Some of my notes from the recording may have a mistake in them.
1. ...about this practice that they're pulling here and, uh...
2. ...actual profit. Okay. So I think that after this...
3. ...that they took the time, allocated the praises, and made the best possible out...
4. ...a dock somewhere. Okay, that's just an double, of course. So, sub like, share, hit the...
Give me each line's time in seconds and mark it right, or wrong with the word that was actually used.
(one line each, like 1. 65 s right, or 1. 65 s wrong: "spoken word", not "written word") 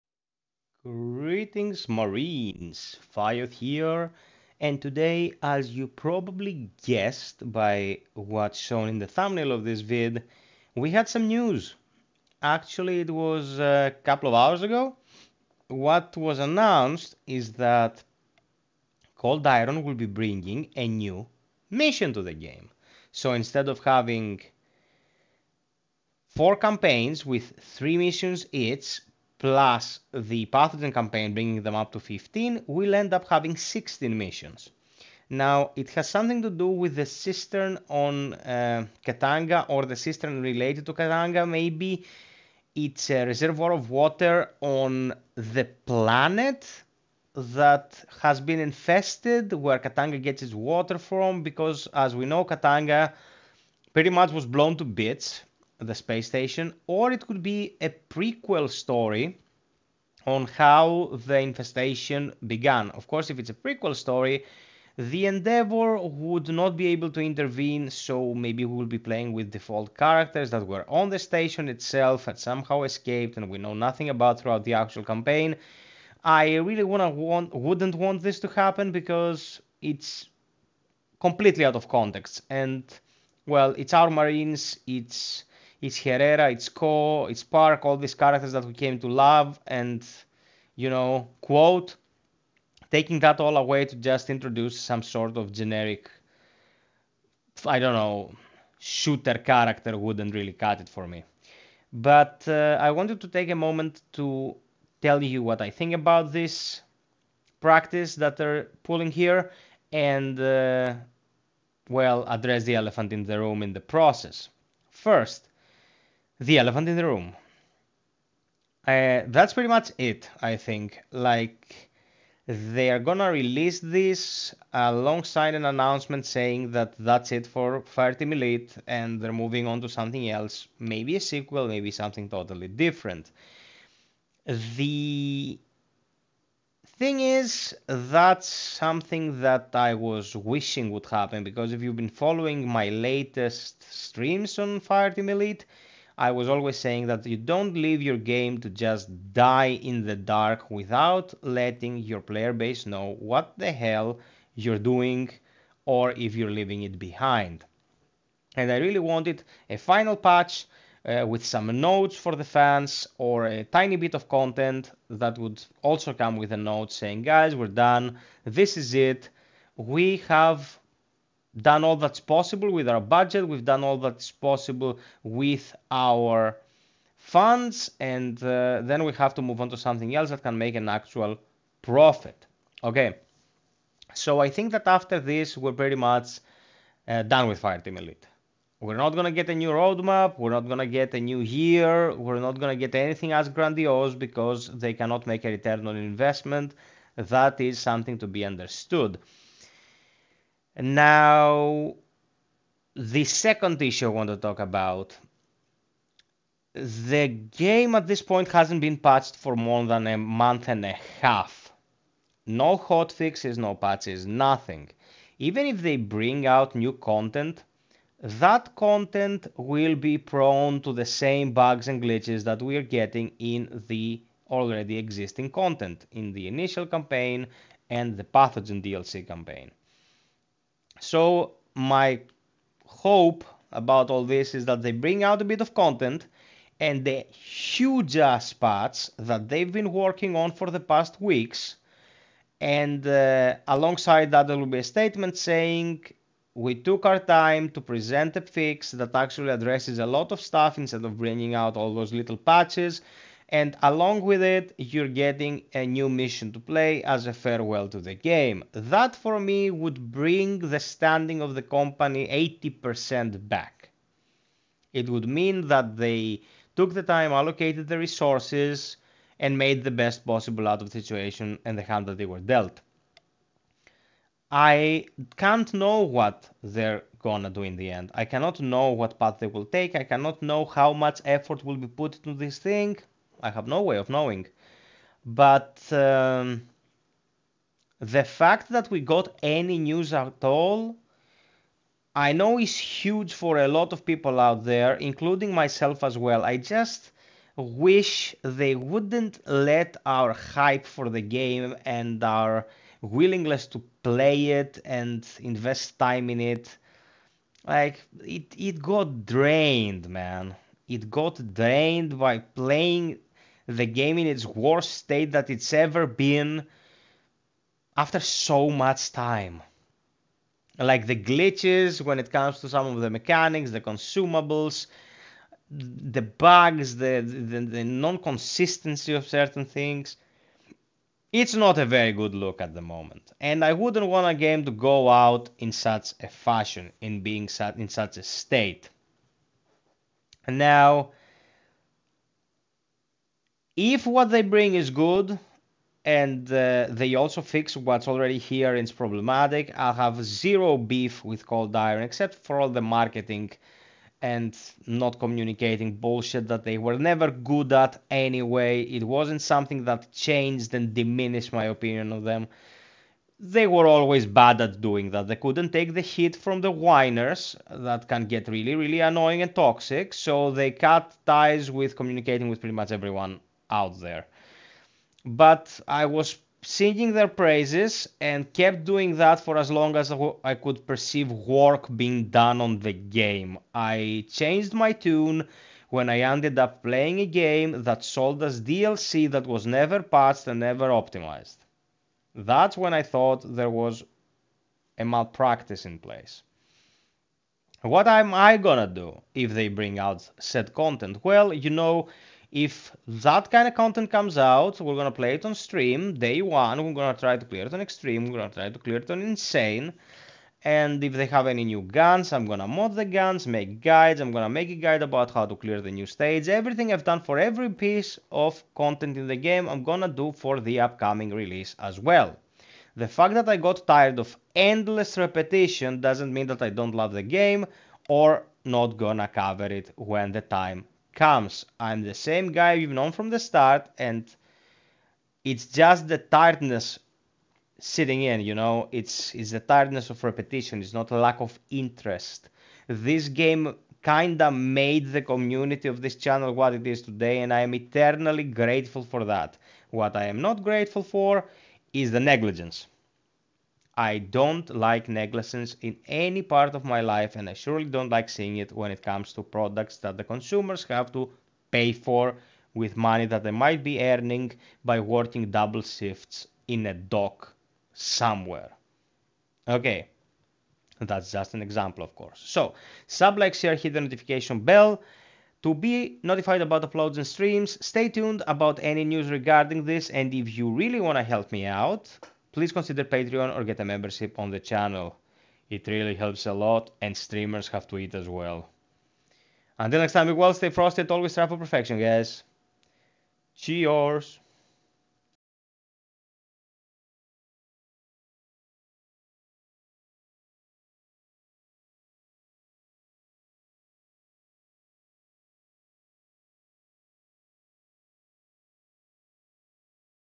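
1. 105 s right
2. 180 s right
3. 265 s wrong: "resources", not "praises"
4. 466 s wrong: "example", not "double".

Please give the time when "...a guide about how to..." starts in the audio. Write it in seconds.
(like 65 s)
414 s.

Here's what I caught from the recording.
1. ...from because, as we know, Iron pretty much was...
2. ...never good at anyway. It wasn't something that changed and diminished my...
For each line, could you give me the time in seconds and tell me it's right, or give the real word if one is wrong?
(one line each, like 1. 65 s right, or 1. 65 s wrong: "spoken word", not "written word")
1. 50 s wrong: "Katanga", not "Iron"
2. 356 s right.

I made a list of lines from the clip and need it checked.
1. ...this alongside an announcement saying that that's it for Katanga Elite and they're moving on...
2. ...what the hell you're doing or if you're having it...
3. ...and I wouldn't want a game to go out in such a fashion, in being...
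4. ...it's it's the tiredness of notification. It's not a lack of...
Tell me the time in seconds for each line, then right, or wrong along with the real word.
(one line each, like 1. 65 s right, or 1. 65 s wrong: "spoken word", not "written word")
1. 123 s wrong: "Fireteam", not "Katanga"
2. 153 s wrong: "leaving", not "having"
3. 333 s right
4. 438 s wrong: "repetition", not "notification".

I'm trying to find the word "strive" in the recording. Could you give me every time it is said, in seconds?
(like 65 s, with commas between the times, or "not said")
491 s.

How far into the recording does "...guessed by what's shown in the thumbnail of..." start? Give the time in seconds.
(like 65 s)
6 s.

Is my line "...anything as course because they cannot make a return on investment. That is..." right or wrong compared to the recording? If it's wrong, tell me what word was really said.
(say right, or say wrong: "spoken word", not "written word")
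wrong: "grandiose", not "course".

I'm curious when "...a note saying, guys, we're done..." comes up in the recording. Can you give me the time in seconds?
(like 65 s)
166 s.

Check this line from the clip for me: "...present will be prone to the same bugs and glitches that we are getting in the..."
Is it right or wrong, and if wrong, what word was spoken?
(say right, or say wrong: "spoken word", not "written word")
wrong: "content", not "present".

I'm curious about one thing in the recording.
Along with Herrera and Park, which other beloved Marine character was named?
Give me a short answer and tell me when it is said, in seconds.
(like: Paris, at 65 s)
Co, at 86 s.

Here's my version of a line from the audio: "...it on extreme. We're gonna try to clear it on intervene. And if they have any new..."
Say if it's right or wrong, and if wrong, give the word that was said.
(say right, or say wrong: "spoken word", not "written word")
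wrong: "insane", not "intervene".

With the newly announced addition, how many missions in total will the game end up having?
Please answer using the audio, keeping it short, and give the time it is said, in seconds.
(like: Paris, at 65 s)
16, at 33 s.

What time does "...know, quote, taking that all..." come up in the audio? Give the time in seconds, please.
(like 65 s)
90 s.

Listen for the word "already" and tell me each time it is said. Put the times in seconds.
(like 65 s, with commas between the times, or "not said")
224 s, 348 s.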